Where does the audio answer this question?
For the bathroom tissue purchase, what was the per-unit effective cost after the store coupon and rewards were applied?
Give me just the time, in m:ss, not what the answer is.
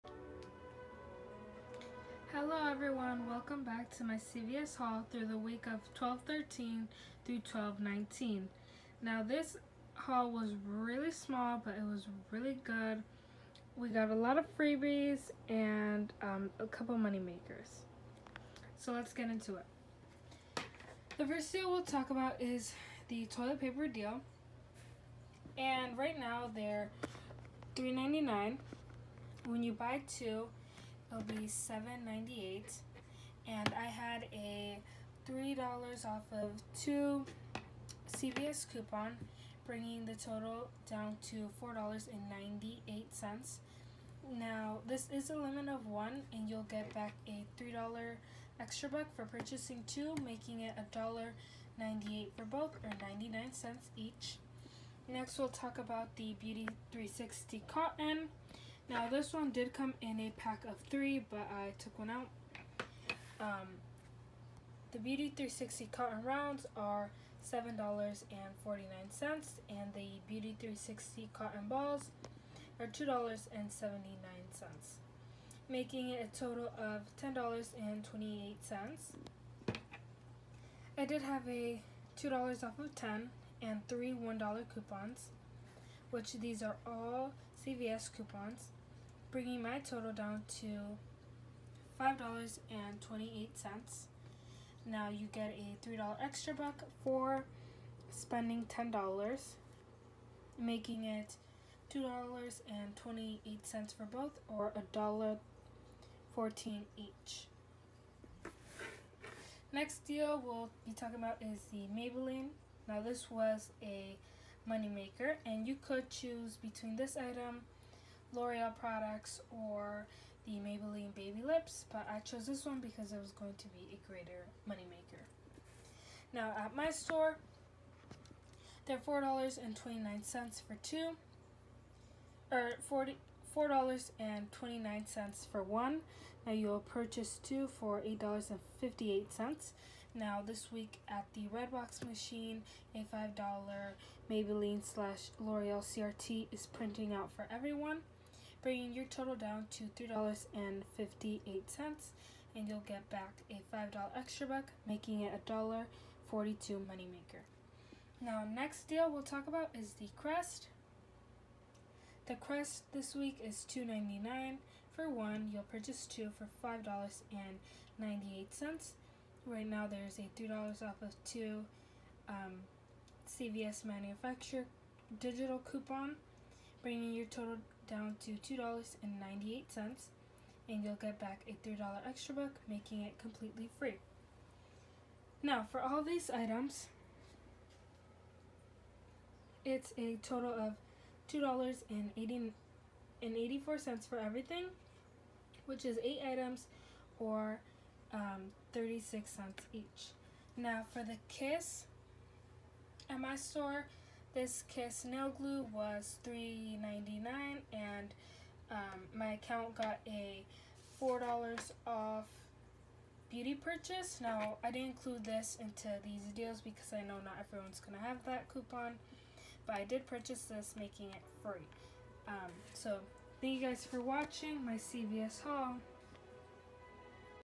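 0:53.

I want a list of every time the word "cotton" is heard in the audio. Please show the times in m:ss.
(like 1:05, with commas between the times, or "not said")
0:57, 1:05, 1:11.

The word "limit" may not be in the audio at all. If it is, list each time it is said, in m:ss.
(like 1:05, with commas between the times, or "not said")
0:45.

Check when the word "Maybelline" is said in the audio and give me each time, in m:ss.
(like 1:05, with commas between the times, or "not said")
1:51, 2:00, 2:24.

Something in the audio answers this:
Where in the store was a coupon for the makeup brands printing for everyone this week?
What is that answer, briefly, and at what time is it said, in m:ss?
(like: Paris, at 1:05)
Redbox machine, at 2:21.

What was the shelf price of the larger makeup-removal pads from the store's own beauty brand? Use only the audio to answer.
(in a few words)
$7.49.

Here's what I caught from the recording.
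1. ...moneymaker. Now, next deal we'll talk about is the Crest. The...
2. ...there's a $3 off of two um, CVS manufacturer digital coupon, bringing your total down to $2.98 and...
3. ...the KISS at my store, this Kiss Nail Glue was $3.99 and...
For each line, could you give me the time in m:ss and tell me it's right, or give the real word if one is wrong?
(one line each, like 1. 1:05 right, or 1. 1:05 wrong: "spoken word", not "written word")
1. 2:36 right
2. 2:49 right
3. 3:21 right.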